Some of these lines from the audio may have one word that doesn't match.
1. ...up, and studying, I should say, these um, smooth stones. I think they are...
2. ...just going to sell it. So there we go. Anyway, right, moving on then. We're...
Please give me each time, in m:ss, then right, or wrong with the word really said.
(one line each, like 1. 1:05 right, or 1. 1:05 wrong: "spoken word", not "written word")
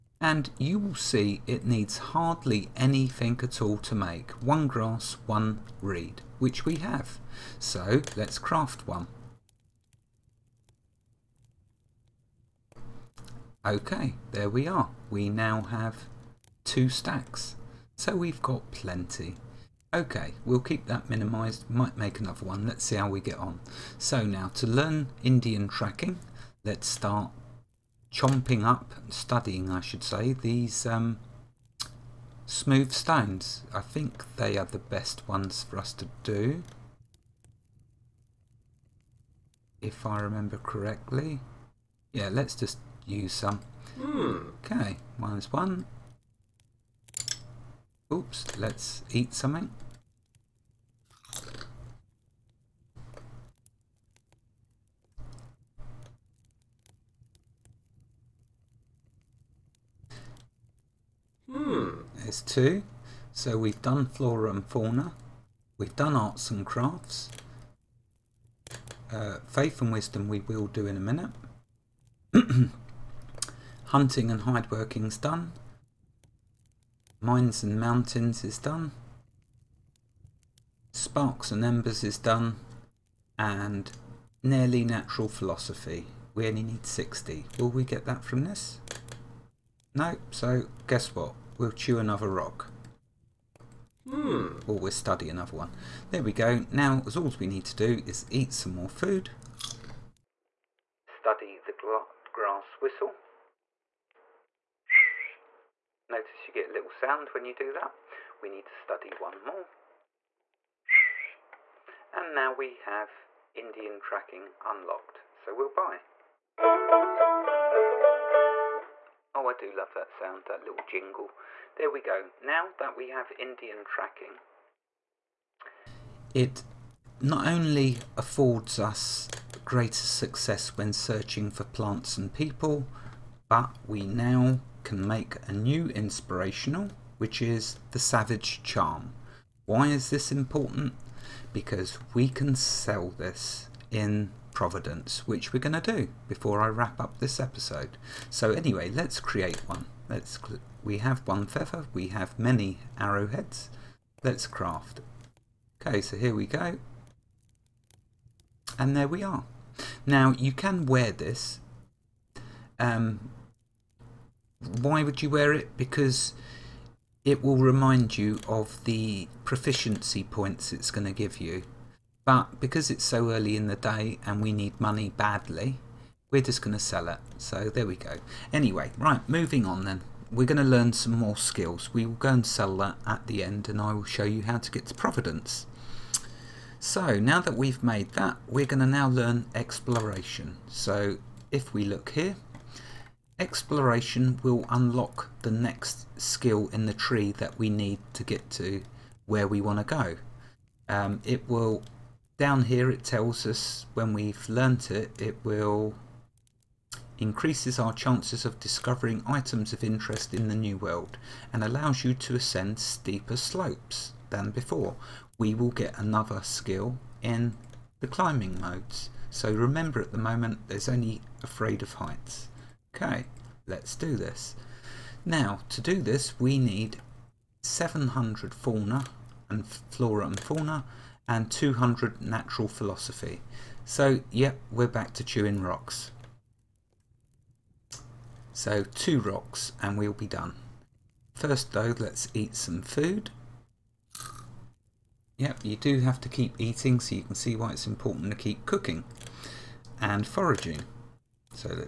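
1. 0:28 right
2. 2:56 right.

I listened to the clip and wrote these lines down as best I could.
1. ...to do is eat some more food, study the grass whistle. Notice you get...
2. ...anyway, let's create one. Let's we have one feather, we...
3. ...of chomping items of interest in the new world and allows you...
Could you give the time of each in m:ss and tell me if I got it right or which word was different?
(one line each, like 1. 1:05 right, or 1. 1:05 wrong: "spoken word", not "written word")
1. 1:37 right
2. 2:28 right
3. 3:28 wrong: "discovering", not "chomping".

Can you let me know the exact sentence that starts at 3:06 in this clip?
So now that we've made that, we're going to now learn exploration.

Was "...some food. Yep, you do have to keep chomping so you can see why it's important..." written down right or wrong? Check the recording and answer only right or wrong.
wrong.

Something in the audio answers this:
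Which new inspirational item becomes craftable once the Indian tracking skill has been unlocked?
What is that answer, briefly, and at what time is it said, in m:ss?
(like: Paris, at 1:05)
Savage Charm, at 2:17.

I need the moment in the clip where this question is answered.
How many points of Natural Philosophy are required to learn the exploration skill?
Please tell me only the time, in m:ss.
3:51.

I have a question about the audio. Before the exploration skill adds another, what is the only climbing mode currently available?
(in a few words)
Afraid of heights.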